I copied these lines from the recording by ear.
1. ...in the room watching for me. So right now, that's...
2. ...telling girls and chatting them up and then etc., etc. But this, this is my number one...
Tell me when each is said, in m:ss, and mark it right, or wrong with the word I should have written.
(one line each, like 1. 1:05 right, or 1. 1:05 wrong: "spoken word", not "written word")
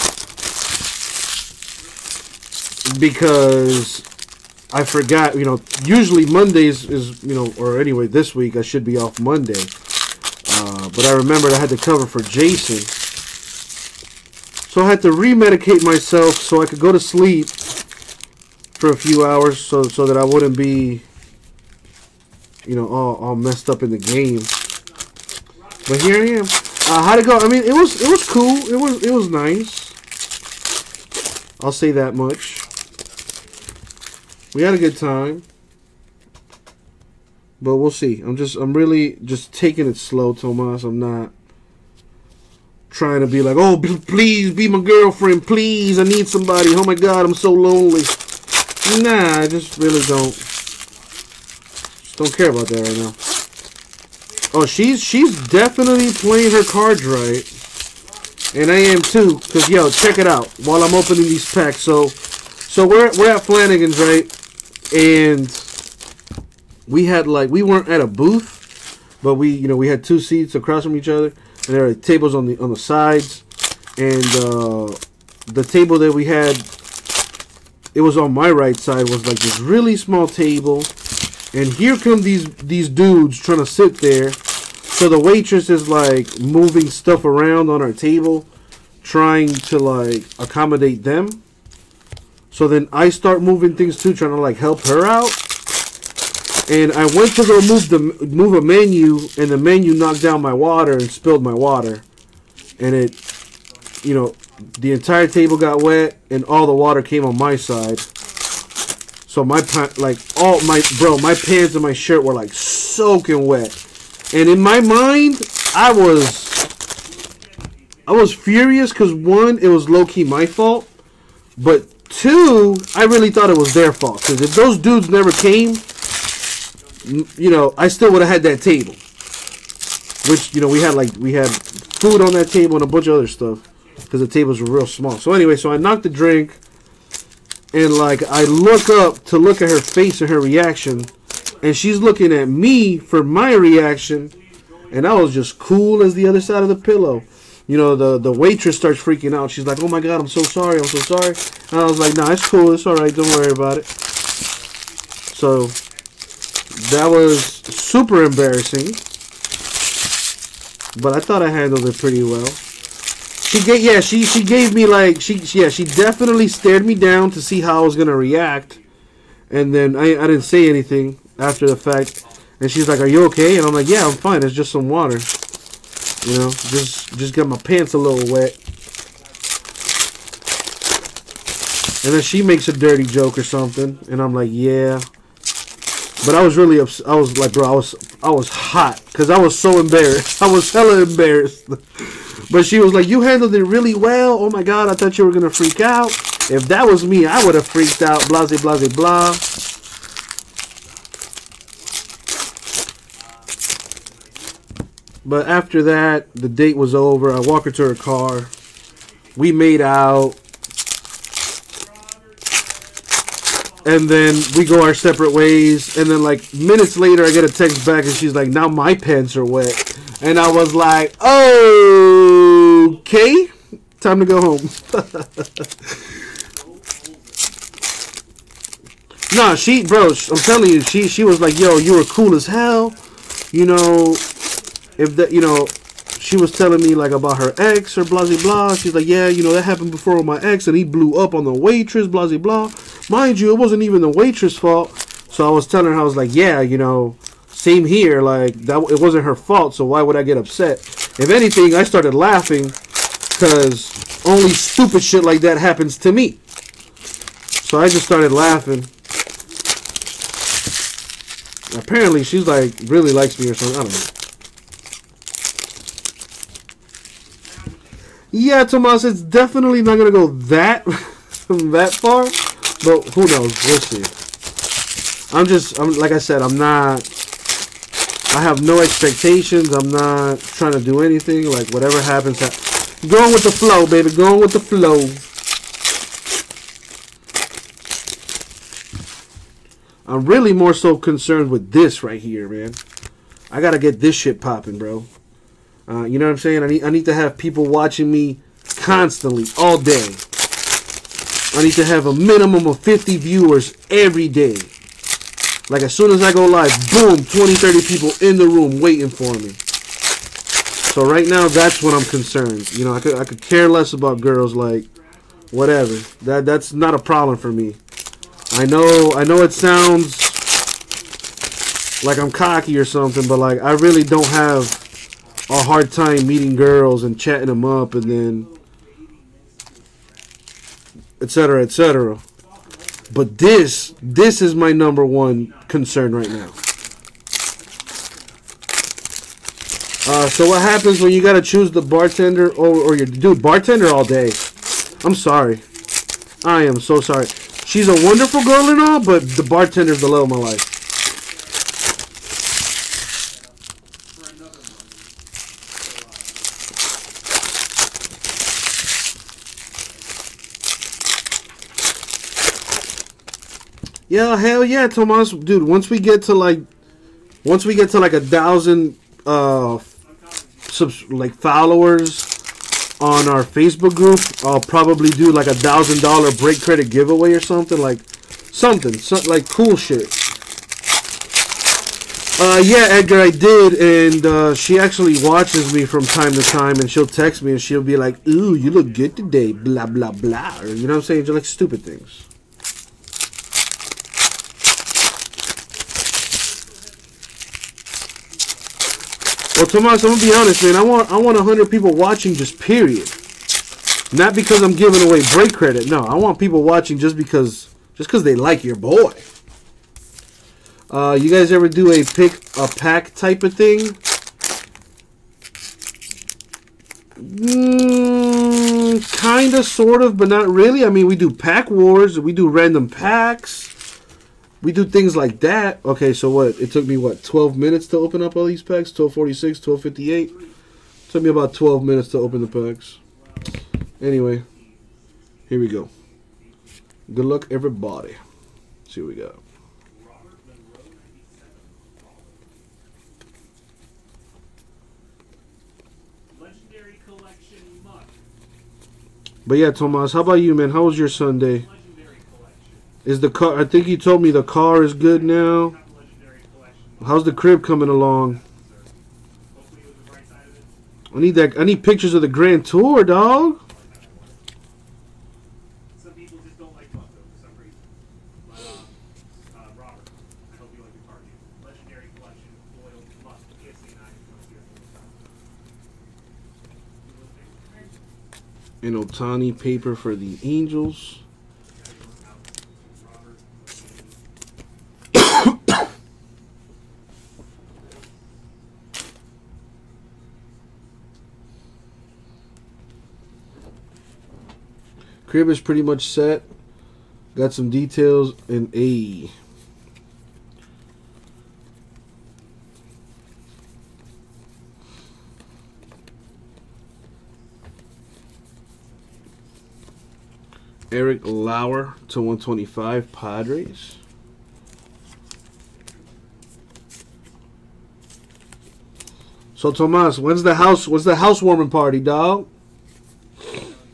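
1. 5:08 wrong: "waiting", not "watching"
2. 5:26 wrong: "meeting", not "telling".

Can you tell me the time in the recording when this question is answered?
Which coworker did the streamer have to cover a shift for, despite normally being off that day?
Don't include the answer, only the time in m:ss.
0:12.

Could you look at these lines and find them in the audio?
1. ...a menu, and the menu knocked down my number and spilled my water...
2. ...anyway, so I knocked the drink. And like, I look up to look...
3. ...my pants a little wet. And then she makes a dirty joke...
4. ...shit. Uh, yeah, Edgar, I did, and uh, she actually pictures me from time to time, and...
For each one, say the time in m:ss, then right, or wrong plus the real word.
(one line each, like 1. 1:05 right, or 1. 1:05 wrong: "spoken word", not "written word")
1. 1:38 wrong: "water", not "number"
2. 2:15 right
3. 2:57 right
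4. 6:19 wrong: "watches", not "pictures".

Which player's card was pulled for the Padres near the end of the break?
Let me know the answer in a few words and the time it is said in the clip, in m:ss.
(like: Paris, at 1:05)
Eric Lauer, at 8:30.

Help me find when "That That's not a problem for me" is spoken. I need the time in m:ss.
5:16.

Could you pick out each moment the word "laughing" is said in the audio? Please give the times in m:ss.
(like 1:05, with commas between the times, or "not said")
4:12, 4:18.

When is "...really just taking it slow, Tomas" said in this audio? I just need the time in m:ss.
0:38.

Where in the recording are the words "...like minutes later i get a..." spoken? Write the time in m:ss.
3:36.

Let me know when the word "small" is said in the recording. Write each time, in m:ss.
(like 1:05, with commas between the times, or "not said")
1:19, 2:14.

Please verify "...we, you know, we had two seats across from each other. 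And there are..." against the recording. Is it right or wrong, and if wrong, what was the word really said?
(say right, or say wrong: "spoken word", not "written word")
right.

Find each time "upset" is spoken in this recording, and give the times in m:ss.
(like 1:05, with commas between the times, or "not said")
3:06, 4:10.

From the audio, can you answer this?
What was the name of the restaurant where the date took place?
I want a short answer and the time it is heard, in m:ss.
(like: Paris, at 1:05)
Flanagan's, at 1:03.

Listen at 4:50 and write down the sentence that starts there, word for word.
I'm really more so concerned with this right here, man.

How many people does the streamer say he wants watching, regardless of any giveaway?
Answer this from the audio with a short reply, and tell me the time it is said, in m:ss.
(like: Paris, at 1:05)
100, at 6:41.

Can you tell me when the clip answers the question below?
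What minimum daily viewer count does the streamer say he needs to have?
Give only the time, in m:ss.
5:02.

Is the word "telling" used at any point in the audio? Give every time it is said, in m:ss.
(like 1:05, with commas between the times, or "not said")
3:50, 3:56, 4:05.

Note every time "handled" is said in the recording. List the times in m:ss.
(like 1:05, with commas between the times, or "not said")
2:41, 3:13.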